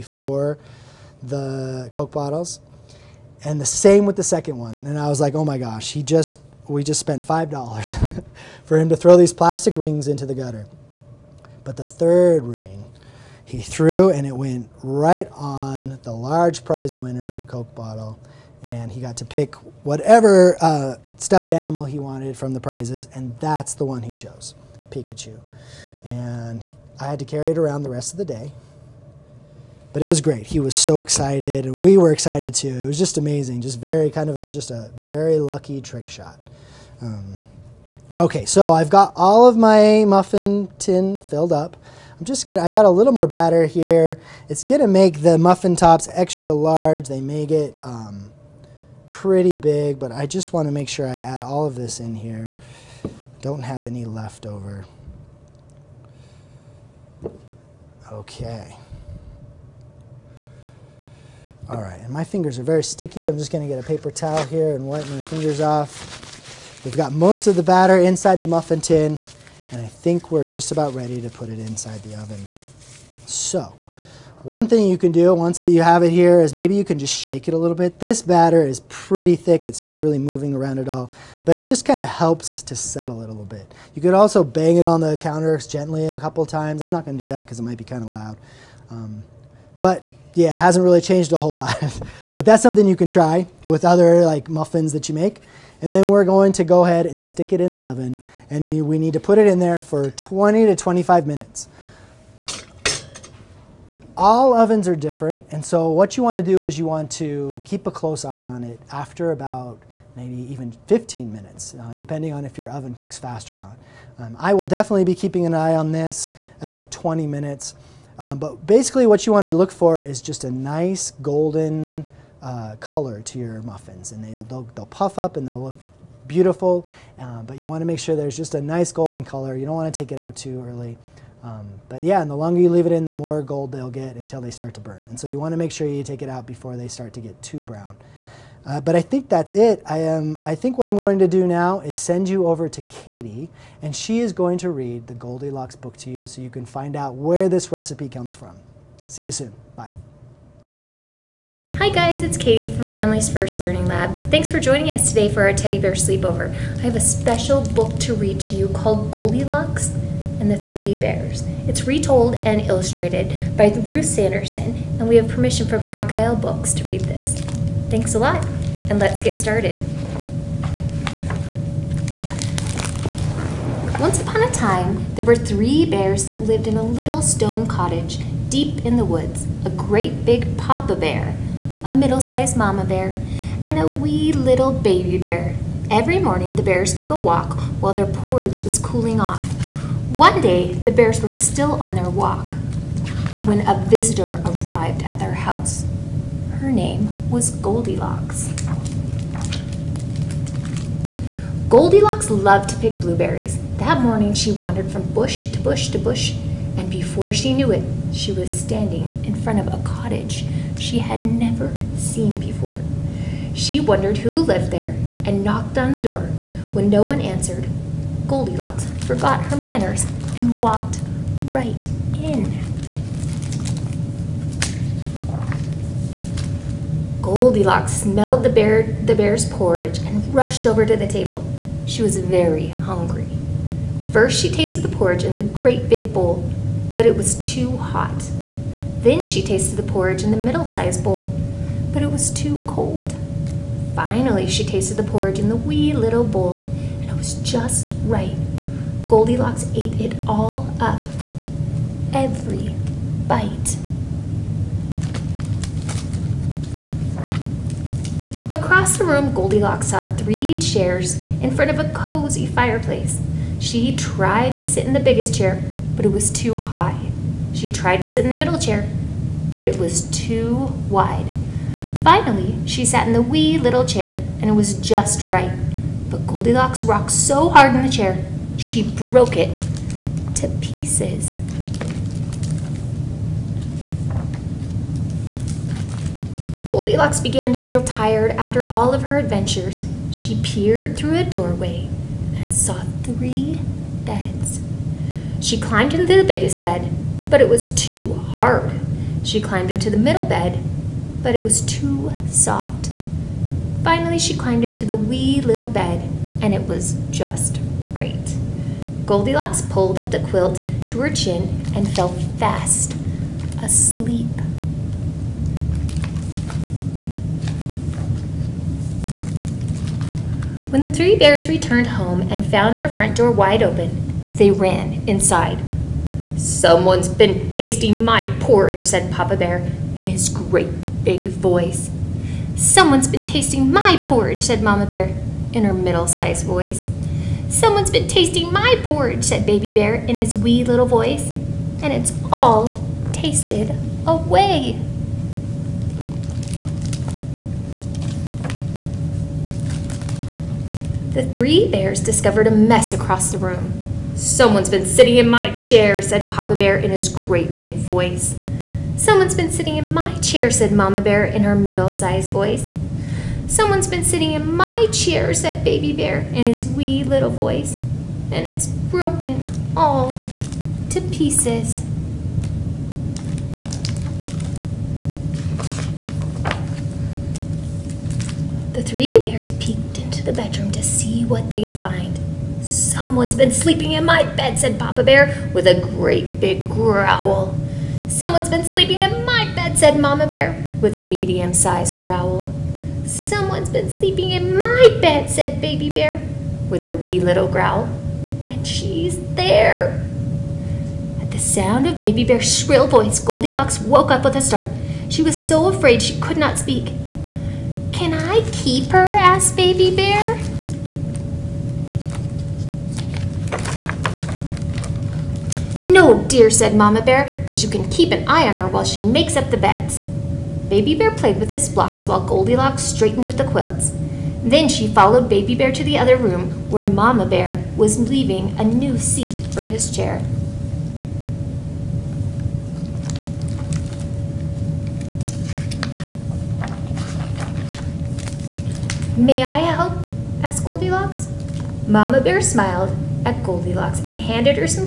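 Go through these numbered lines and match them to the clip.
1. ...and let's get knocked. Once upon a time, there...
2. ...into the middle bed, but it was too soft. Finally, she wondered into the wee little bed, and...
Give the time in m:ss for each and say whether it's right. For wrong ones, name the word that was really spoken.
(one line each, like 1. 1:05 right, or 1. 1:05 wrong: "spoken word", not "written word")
1. 2:48 wrong: "started", not "knocked"
2. 4:59 wrong: "climbed", not "wondered".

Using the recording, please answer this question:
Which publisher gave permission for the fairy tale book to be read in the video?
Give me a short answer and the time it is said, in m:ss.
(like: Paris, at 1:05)
Crocodile Books, at 2:45.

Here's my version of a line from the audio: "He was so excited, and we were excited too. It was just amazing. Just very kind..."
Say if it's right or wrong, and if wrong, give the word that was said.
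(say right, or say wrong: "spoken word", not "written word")
right.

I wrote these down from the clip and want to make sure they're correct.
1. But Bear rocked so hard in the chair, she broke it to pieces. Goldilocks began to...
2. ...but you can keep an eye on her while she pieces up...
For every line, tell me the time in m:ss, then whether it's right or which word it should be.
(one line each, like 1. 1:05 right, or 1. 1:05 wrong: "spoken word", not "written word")
1. 4:36 wrong: "Goldilocks", not "Bear"
2. 6:57 wrong: "makes", not "pieces".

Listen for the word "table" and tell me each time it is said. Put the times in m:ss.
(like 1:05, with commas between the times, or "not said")
3:51.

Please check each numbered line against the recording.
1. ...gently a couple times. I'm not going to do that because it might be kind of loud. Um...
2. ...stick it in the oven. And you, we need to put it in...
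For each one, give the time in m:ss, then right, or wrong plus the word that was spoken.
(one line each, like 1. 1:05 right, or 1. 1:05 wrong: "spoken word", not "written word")
1. 1:25 right
2. 1:37 right.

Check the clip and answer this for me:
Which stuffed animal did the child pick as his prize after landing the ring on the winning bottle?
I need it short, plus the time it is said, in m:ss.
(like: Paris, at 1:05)
Pikachu, at 0:24.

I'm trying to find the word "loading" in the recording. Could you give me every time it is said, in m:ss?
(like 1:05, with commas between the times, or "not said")
not said.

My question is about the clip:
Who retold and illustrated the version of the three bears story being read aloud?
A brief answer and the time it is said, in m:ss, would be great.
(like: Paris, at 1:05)
Ruth Sanderson, at 2:43.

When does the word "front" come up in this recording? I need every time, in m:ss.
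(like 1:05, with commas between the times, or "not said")
3:29, 4:21, 5:22.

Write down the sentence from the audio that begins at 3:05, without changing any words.
Every morning, the bears took a walk while their porridge was cooling off.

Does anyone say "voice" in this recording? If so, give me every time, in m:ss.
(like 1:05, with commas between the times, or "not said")
5:31, 5:36, 5:40, 5:57, 6:02, 6:07, 6:42.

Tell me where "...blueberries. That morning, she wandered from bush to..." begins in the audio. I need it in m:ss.
3:22.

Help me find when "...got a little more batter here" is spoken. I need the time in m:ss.
0:42.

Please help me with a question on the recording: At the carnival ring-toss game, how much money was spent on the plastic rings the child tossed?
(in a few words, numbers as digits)
$5.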